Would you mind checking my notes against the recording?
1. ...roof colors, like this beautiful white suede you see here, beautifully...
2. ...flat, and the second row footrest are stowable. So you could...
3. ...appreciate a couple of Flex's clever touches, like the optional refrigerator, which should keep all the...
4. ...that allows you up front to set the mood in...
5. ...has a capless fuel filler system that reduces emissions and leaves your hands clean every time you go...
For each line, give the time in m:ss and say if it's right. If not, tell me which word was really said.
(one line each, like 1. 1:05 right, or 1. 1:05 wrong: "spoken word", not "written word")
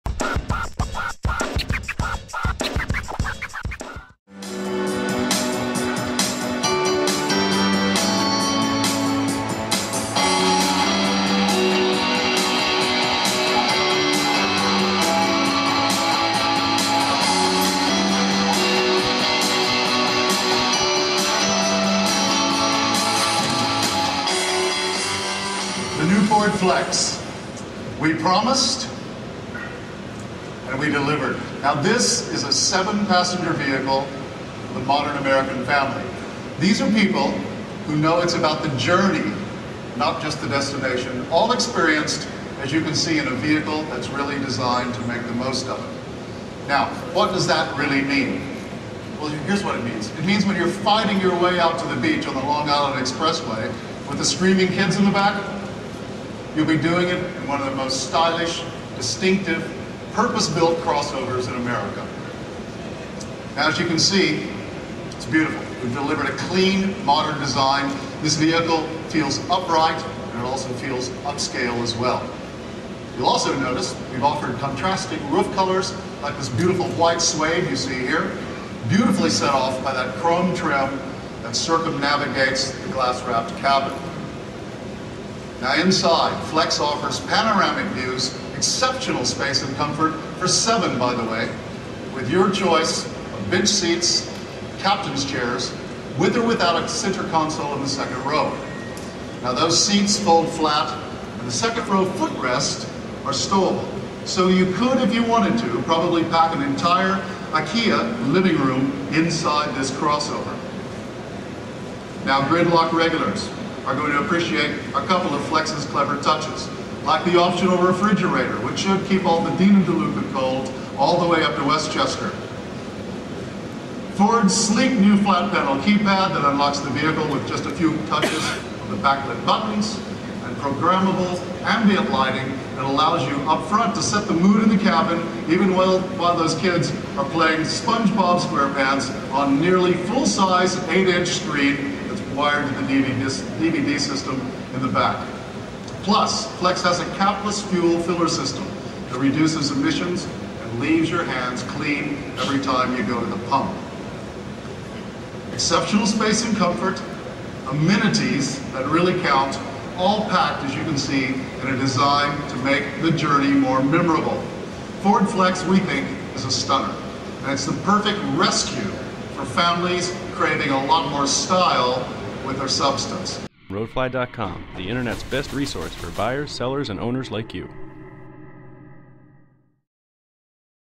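1. 1:15 right
2. 1:40 right
3. 1:54 right
4. 2:12 right
5. 2:26 right.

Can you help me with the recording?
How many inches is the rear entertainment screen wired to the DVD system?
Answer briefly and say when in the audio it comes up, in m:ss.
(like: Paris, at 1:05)
8, at 2:20.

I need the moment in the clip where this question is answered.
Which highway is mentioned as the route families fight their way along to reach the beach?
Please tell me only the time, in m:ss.
0:52.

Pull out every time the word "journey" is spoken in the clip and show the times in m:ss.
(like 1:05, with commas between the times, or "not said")
0:38, 2:43.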